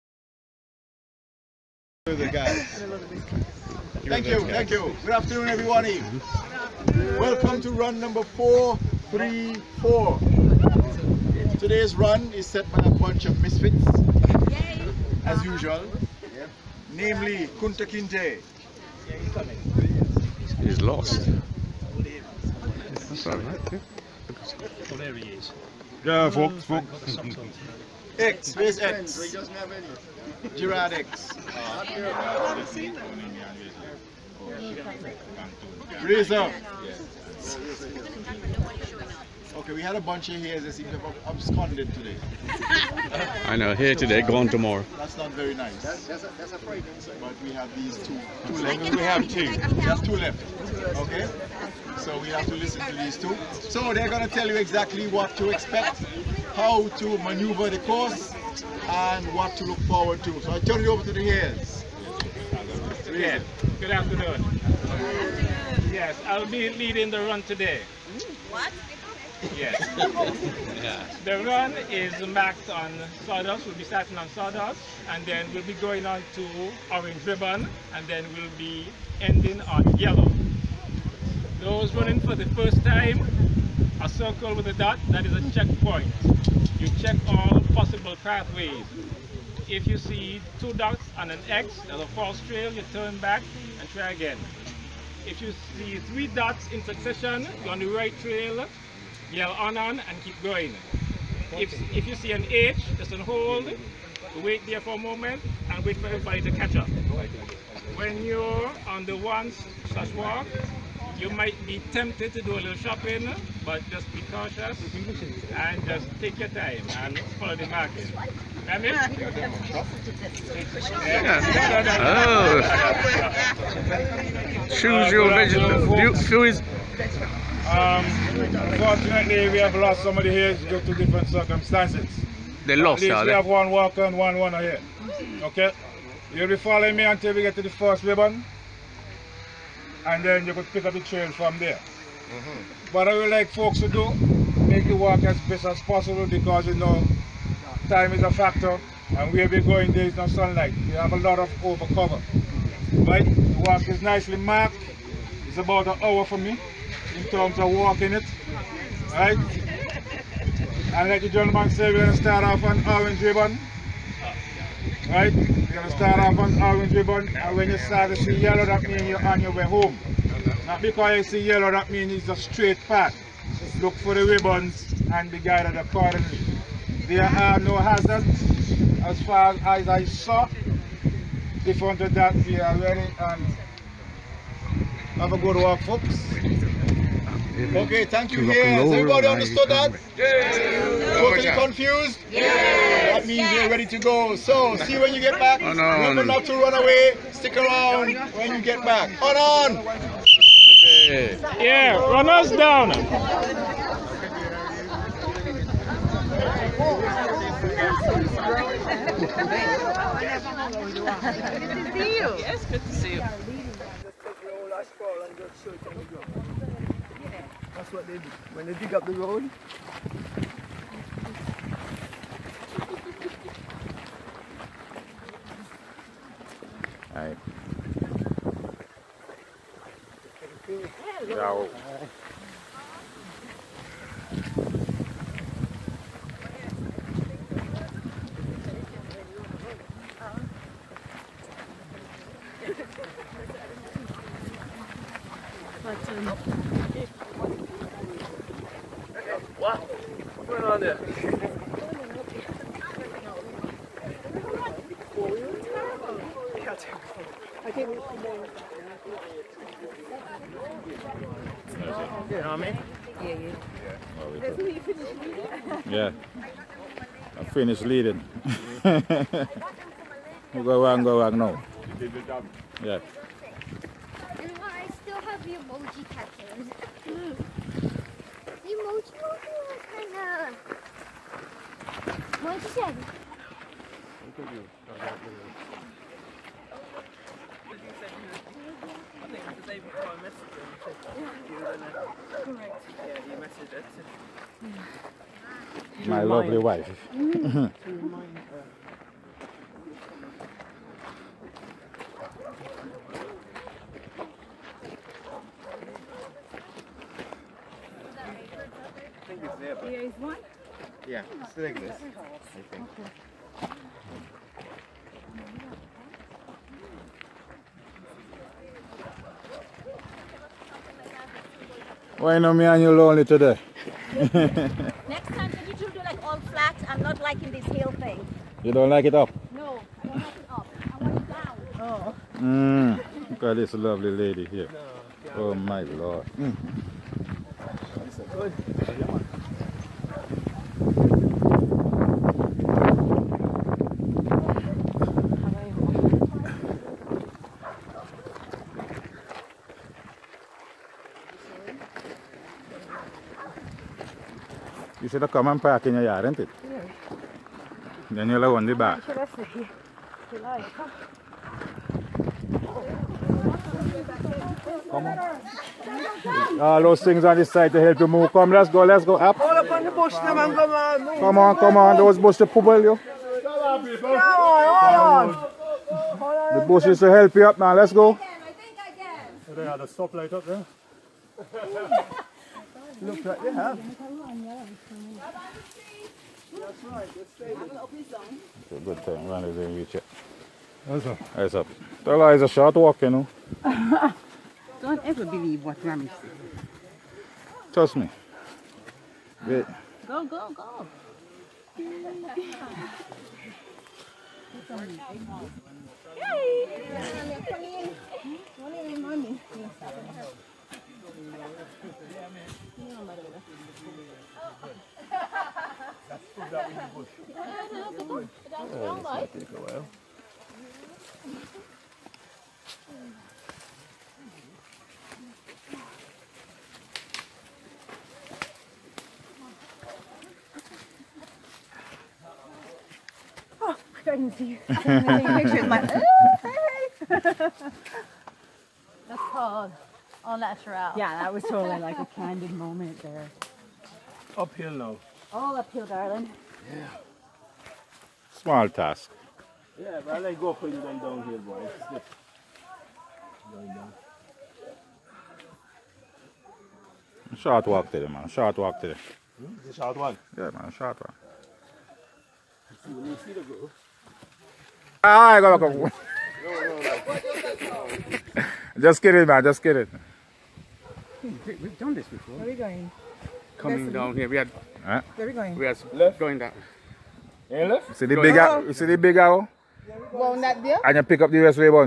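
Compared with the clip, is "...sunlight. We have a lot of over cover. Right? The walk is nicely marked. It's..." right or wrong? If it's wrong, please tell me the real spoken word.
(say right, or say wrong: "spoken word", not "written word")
right.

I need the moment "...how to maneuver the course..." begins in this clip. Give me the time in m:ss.
0:56.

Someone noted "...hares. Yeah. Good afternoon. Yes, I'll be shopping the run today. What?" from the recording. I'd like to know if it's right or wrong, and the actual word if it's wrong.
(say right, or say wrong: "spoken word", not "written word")
wrong: "leading", not "shopping".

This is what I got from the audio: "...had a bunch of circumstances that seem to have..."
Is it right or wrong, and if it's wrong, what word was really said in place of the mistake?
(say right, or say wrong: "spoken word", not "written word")
wrong: "hares", not "circumstances".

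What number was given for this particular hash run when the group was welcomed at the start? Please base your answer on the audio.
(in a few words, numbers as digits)
434.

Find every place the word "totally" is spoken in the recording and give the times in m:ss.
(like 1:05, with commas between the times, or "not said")
3:10, 7:21.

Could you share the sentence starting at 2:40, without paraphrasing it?
And like the gentleman said, we're going to start off on orange ribbon, right?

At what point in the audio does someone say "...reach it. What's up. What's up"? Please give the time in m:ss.
6:29.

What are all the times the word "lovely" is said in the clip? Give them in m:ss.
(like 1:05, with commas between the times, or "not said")
4:56, 5:33.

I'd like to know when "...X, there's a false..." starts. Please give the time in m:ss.
1:31.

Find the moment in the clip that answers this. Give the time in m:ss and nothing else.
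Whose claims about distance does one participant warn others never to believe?
6:35.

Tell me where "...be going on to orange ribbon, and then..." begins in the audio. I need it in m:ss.
1:15.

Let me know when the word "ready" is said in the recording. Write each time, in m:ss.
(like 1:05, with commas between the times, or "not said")
3:02, 3:13.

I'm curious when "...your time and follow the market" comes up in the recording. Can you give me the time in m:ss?
1:56.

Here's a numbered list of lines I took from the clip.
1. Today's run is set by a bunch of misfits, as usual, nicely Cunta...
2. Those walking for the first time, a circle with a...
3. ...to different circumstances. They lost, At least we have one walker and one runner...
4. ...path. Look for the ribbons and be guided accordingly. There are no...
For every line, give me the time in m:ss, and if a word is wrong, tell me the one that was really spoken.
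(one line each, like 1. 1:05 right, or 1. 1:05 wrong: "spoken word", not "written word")
1. 0:11 wrong: "namely", not "nicely"
2. 1:21 wrong: "running", not "walking"
3. 2:10 right
4. 2:52 right.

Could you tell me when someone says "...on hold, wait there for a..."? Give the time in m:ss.
1:43.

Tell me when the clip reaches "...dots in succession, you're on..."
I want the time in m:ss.
1:36.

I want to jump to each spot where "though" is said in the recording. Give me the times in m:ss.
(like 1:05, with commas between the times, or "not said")
7:24.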